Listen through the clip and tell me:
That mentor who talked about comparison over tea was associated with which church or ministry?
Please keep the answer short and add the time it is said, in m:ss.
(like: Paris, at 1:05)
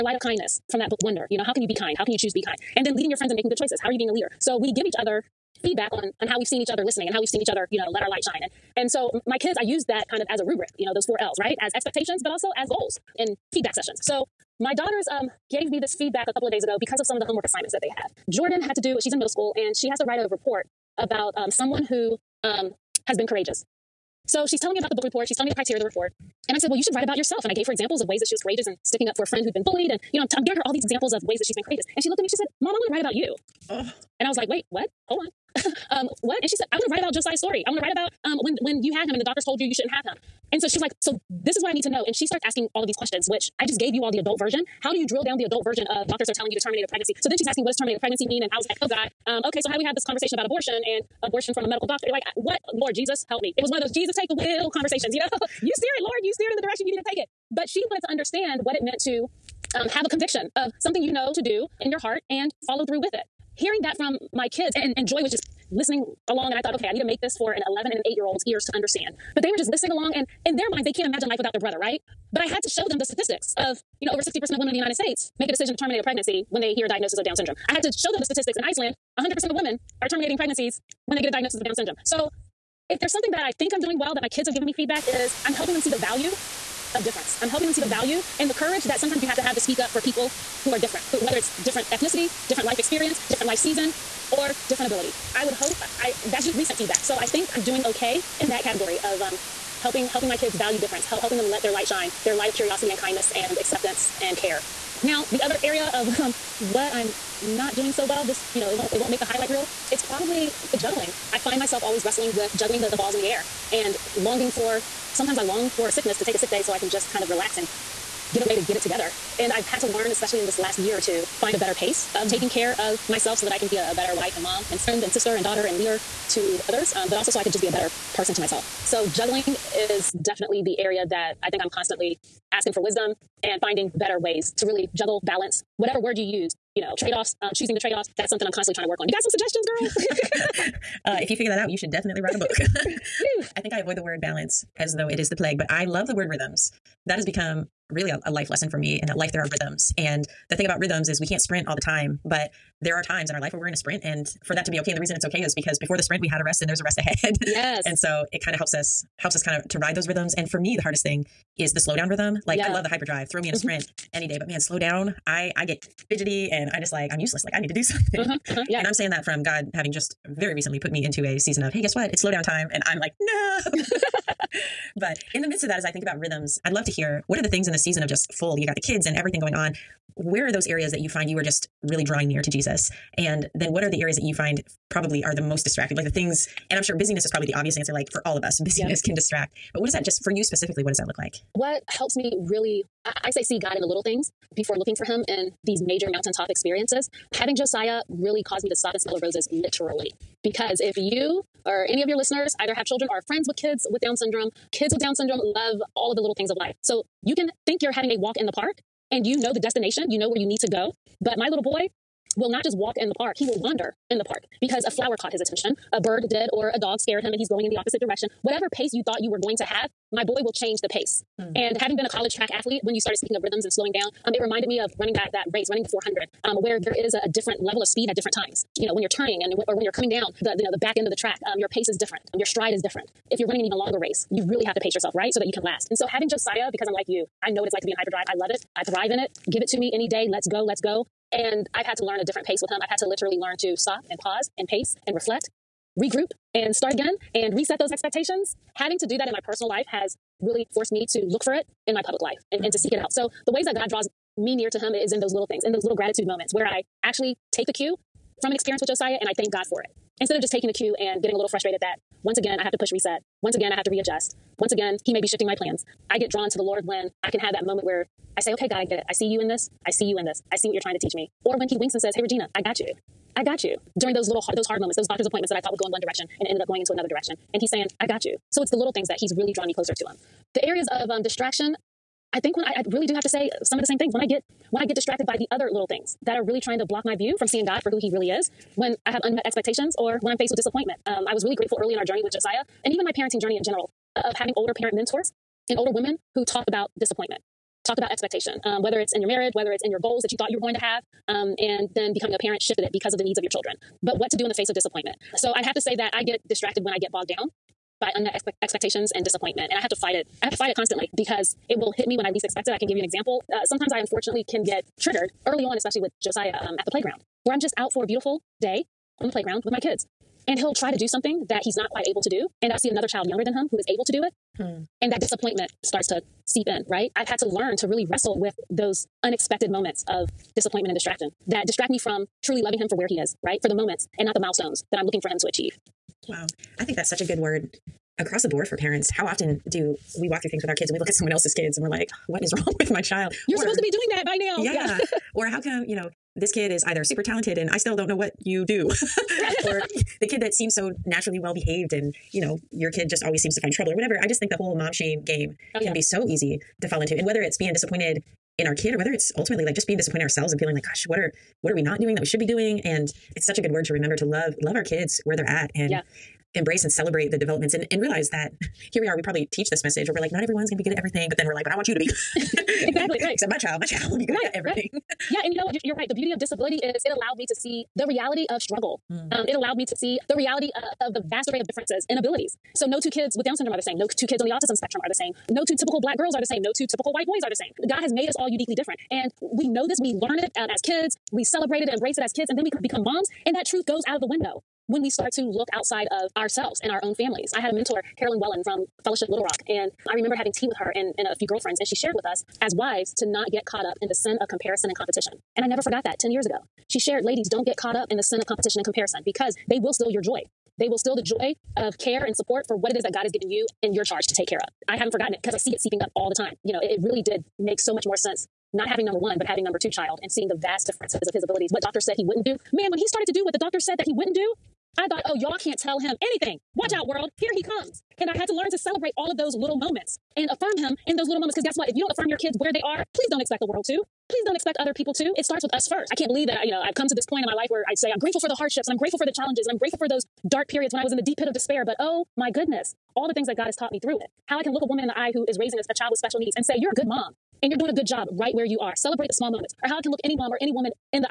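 Fellowship Little Rock, at 6:39.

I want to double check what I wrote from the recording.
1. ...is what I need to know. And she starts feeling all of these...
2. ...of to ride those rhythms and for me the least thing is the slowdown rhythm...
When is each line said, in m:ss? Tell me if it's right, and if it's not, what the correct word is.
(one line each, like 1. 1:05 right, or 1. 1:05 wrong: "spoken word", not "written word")
1. 0:41 wrong: "asking", not "feeling"
2. 2:39 wrong: "hardest", not "least".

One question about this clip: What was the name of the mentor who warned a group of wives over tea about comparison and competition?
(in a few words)
Carolyn Wellen.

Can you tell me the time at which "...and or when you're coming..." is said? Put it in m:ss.
3:49.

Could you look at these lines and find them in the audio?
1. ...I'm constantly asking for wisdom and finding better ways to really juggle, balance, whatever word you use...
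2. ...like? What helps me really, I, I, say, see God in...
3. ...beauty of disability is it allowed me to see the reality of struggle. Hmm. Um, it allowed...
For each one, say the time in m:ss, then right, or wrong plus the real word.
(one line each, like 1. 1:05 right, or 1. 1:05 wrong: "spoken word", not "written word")
1. 2:11 right
2. 3:11 right
3. 6:16 right.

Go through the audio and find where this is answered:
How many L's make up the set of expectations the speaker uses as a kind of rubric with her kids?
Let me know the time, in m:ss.
0:11.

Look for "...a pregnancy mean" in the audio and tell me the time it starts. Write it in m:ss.
0:47.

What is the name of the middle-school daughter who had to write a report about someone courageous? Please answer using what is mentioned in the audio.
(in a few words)
Jordan.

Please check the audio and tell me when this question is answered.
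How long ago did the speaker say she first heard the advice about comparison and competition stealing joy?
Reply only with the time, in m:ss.
6:46.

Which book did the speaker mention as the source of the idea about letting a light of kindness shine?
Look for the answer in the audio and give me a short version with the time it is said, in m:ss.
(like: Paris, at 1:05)
Wonder, at 0:01.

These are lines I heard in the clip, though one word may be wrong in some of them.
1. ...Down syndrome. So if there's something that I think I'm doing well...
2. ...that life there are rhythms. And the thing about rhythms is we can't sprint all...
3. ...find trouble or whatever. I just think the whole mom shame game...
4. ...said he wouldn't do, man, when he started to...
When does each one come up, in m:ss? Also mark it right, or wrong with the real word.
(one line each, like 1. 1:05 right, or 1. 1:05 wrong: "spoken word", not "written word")
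1. 1:21 right
2. 2:29 right
3. 5:53 right
4. 7:02 right.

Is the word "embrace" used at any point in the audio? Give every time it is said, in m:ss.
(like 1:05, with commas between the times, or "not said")
6:06, 6:31.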